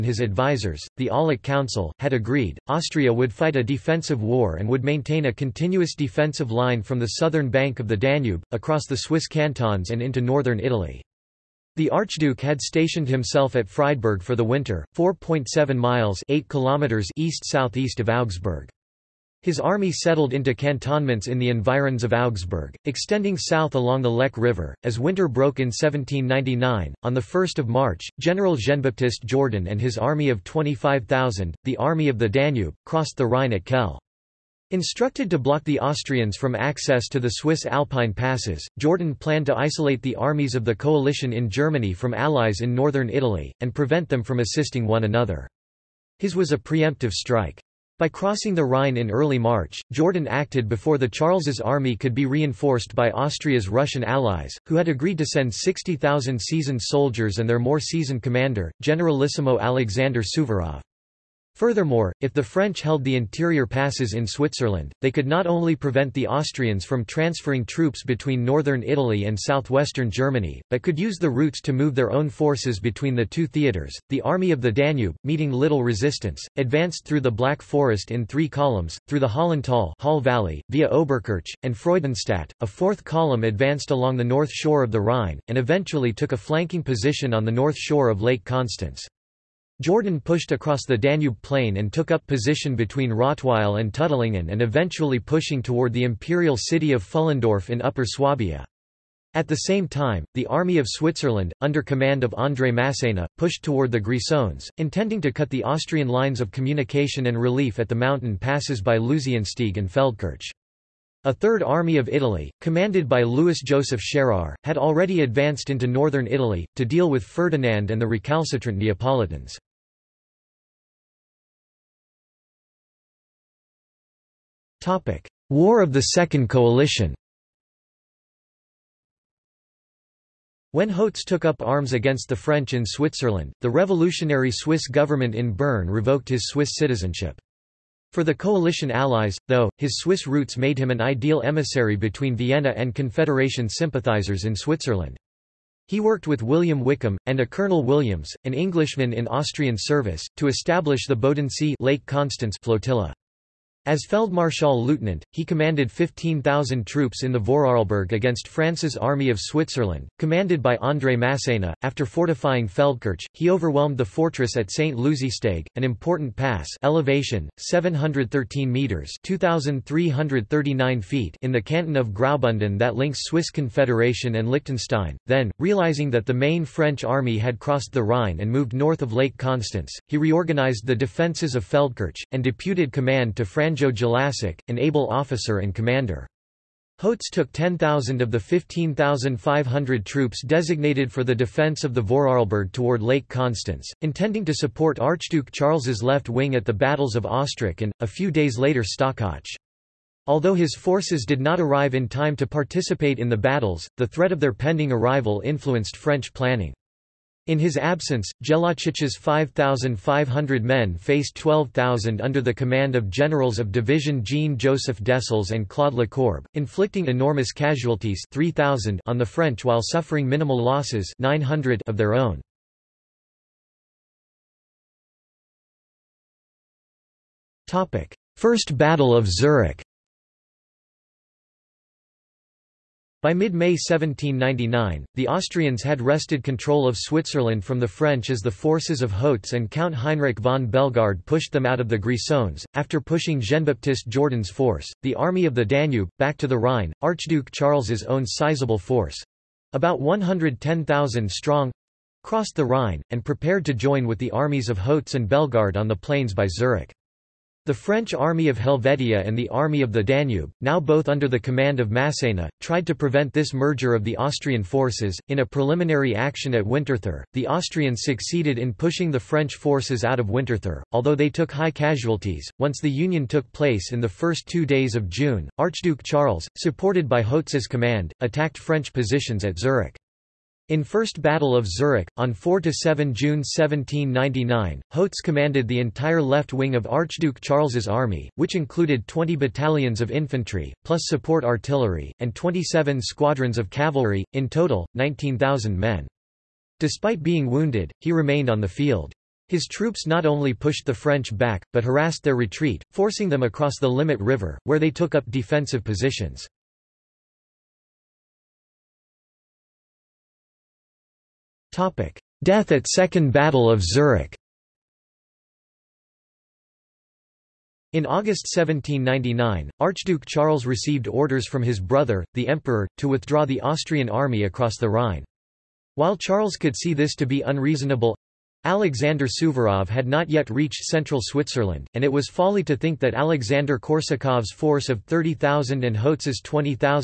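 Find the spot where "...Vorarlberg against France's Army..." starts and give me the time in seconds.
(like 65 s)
157 s.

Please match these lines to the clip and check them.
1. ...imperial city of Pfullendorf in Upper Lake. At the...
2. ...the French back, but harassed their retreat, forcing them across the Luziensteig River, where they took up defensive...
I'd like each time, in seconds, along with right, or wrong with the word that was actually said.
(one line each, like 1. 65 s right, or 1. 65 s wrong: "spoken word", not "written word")
1. 96 s wrong: "Swabia", not "Lake"
2. 300 s wrong: "Limmat", not "Luziensteig".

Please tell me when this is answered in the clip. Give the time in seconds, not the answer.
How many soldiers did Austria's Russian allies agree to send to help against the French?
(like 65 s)
55 s.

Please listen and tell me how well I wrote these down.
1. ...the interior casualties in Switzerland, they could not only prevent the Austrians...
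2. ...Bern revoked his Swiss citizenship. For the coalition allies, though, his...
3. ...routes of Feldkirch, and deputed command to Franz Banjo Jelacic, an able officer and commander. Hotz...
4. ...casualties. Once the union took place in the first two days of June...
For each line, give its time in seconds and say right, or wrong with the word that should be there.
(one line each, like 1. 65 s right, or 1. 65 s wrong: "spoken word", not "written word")
1. 63 s wrong: "passes", not "casualties"
2. 135 s right
3. 180 s wrong: "defences", not "routes"
4. 271 s right.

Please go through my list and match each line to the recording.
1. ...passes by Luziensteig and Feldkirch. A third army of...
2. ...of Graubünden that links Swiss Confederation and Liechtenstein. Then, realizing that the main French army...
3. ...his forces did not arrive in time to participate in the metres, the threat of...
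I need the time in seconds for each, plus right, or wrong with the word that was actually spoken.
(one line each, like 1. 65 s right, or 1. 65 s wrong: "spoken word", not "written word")
1. 108 s right
2. 171 s right
3. 200 s wrong: "battles", not "metres".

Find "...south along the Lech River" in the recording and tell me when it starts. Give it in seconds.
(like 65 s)
23 s.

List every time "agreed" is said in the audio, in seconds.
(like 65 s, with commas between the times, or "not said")
2 s, 54 s.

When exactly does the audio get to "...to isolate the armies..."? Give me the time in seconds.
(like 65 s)
39 s.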